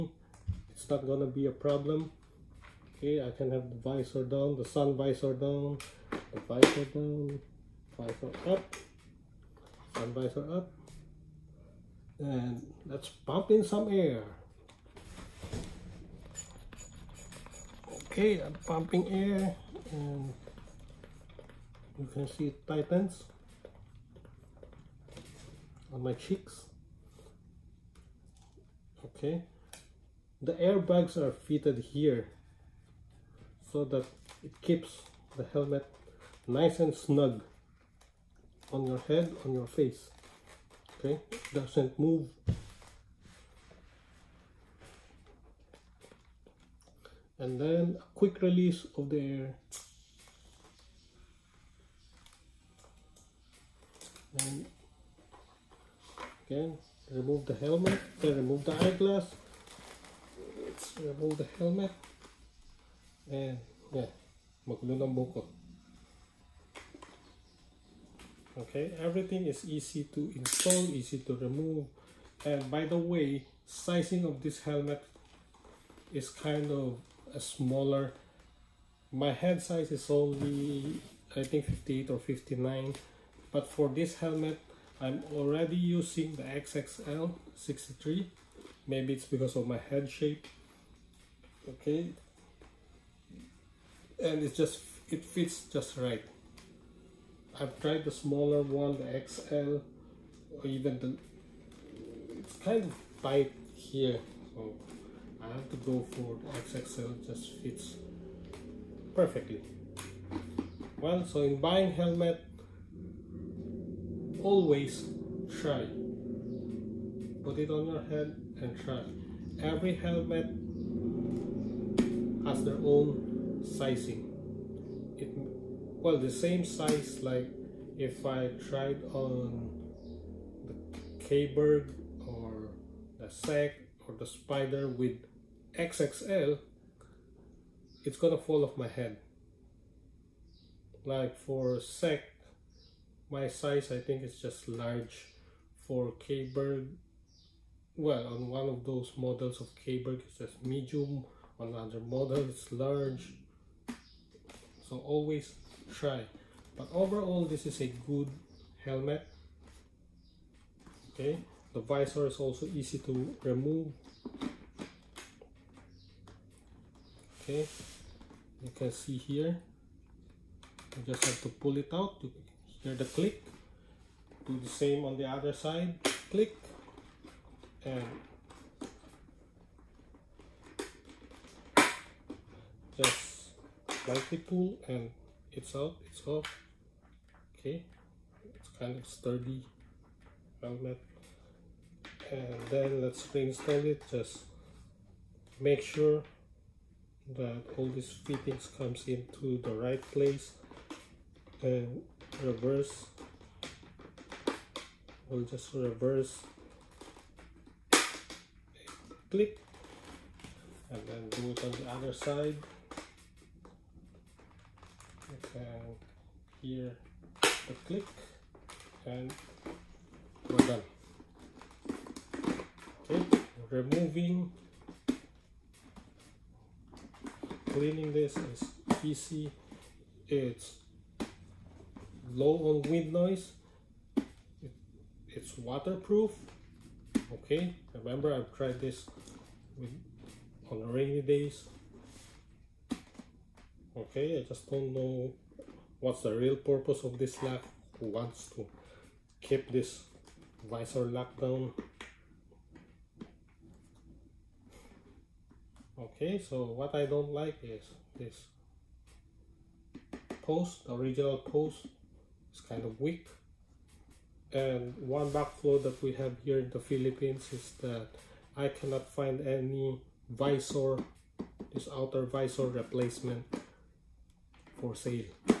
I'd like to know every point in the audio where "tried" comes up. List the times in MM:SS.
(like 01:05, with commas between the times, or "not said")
01:37, 02:08, 03:58.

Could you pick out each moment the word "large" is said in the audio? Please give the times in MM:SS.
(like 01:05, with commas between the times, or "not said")
02:24, 02:32.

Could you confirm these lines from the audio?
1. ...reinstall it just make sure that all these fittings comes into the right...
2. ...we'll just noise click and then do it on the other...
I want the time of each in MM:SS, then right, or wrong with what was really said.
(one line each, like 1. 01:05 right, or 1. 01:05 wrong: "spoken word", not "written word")
1. 03:13 right
2. 03:25 wrong: "reverse", not "noise".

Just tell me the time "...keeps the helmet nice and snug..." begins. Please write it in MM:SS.
00:34.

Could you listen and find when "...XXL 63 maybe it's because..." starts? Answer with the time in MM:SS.
01:26.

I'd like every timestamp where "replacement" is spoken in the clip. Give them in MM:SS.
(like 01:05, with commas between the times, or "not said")
04:32.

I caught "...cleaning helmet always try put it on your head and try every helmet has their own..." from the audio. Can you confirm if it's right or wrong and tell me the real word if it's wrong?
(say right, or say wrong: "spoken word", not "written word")
wrong: "buying", not "cleaning".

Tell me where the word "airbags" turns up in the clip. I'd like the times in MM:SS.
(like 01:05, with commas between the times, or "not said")
00:30.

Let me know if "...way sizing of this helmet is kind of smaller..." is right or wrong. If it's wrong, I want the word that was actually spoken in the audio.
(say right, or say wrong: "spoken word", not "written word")
right.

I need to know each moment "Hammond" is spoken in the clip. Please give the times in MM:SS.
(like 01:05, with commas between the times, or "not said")
not said.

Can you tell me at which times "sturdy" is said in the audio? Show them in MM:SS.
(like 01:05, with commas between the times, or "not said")
03:09.